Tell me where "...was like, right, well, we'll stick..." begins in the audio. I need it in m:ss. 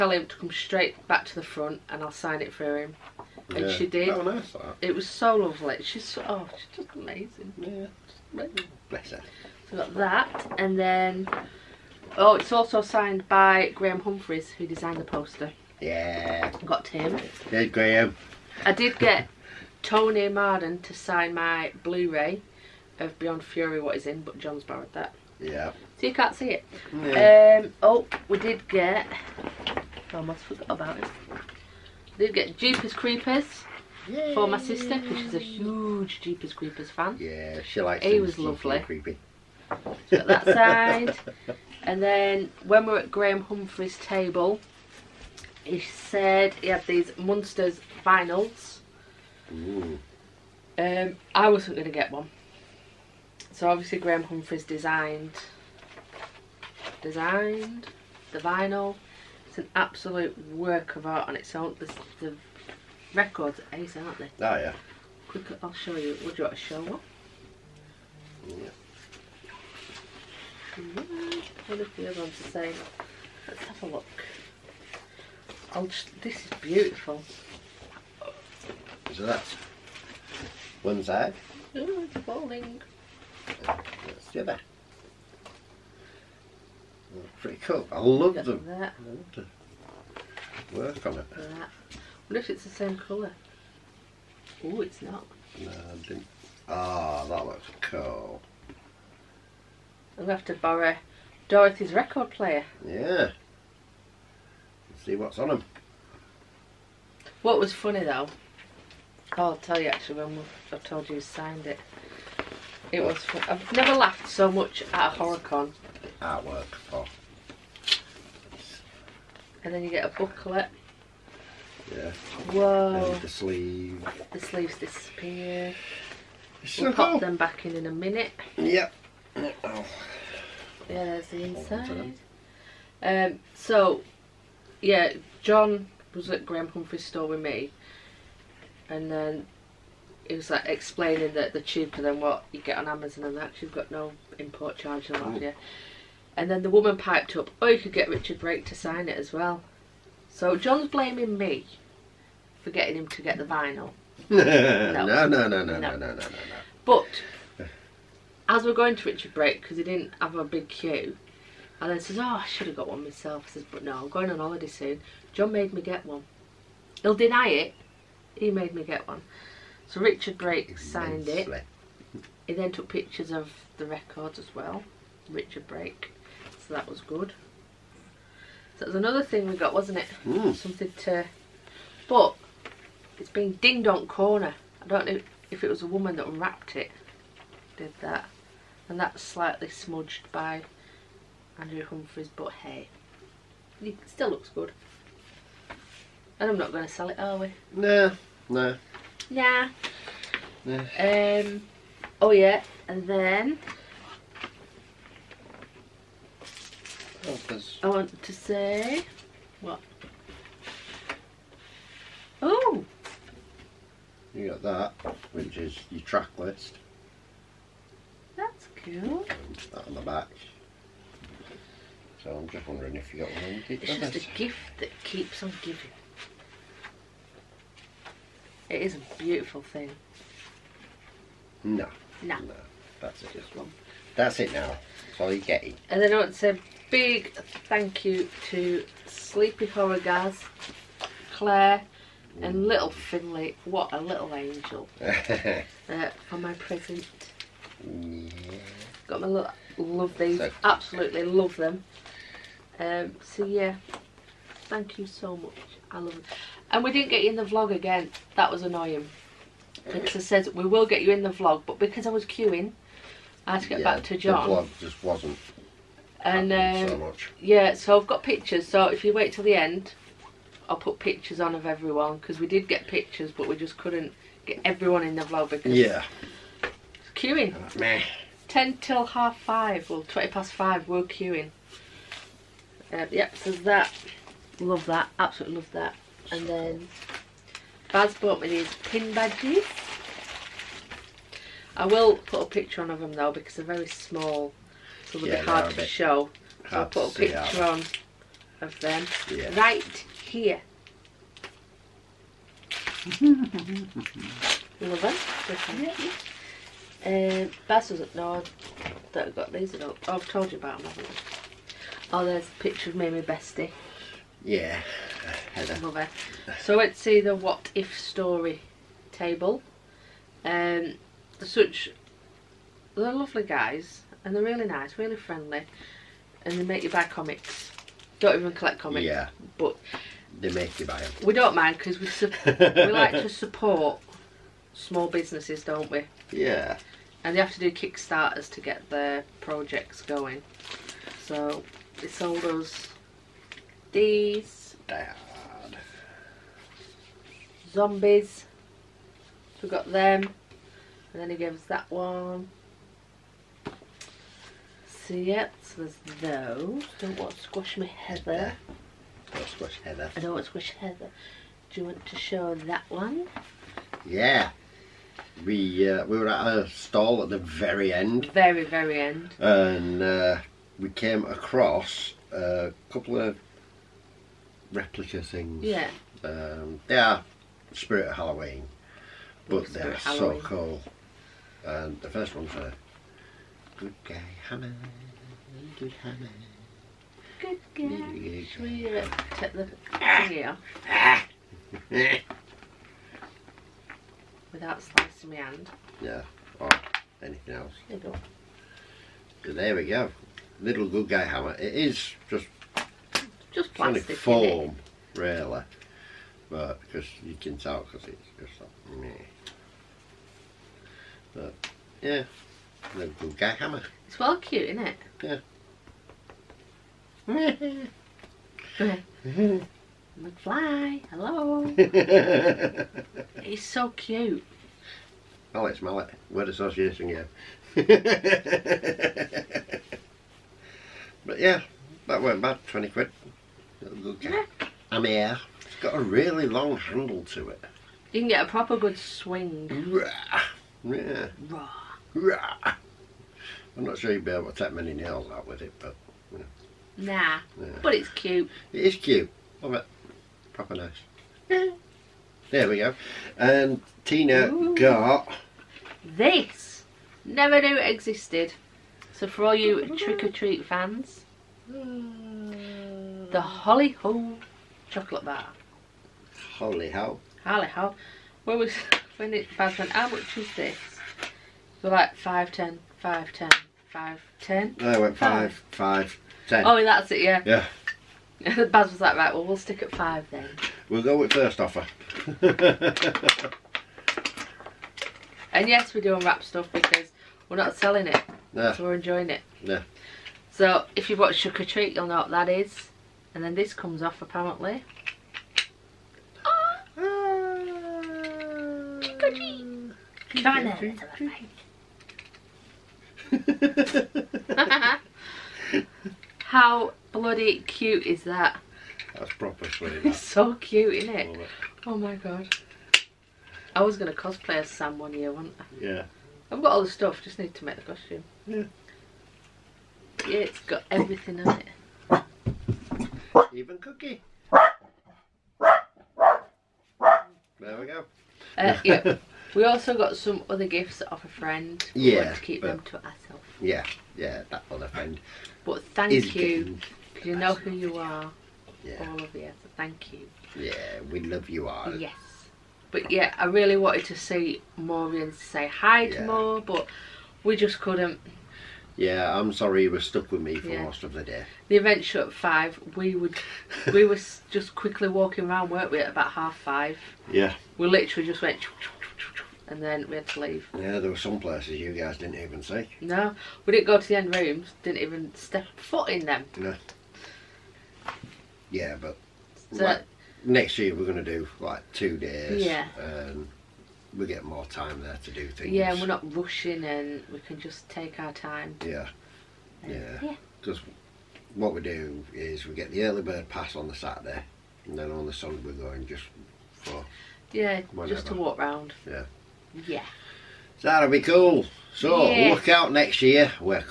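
7:58.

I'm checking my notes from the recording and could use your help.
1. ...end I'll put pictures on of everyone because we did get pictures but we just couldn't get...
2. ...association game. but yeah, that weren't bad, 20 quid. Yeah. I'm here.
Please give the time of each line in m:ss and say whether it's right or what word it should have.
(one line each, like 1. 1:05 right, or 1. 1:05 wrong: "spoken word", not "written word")
1. 4:29 right
2. 7:06 right.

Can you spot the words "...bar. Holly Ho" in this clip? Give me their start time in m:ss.
7:45.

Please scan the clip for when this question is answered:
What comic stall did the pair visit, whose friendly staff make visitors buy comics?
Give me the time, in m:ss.
5:17.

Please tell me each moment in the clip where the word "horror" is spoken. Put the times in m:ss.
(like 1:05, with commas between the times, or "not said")
1:55, 3:59.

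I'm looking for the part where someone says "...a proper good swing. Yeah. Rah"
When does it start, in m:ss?
7:18.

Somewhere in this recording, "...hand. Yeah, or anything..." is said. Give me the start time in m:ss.
6:35.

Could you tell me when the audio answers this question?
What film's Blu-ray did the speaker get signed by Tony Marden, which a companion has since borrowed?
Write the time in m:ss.
0:23.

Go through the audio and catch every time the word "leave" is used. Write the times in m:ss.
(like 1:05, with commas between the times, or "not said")
9:20.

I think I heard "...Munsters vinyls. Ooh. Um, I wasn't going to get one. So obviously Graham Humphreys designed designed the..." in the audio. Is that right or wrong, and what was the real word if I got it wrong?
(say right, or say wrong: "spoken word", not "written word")
right.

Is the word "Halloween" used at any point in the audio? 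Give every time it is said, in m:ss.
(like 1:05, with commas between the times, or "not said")
6:18.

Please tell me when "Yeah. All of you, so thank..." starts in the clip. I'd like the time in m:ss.
8:58.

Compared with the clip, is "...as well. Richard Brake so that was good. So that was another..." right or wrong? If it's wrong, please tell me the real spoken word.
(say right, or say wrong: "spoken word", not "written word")
right.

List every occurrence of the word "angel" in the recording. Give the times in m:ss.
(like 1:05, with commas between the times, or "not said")
4:04.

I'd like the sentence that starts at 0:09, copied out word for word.
So got that, and then oh, it's also signed by Graham Humphreys, who designed the poster.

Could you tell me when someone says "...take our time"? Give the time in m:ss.
9:37.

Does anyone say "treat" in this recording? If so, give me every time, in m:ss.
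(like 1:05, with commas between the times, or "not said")
7:40, 8:11, 8:19.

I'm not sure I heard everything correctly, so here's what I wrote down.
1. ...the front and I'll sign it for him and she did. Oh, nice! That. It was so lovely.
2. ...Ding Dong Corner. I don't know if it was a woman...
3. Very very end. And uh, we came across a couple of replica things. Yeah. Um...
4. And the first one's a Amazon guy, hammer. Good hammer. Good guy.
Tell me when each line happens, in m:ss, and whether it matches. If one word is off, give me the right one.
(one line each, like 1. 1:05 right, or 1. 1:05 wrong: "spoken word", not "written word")
1. 0:01 right
2. 3:03 right
3. 6:08 right
4. 6:21 wrong: "Good", not "Amazon".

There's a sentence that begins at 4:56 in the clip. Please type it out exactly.
So I'll put a picture on of them yeah.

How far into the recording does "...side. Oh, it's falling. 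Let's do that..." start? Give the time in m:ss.
1:21.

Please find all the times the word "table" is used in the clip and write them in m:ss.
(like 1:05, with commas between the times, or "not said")
0:43, 5:19.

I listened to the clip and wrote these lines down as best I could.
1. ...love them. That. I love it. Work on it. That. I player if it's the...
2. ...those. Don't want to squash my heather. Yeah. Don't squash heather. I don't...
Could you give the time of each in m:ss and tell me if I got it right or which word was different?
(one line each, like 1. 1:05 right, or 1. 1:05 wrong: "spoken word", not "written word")
1. 1:28 wrong: "wonder", not "player"
2. 5:56 right.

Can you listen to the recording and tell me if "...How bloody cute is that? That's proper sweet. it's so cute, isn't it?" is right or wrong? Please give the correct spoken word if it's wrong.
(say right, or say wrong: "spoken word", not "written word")
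right.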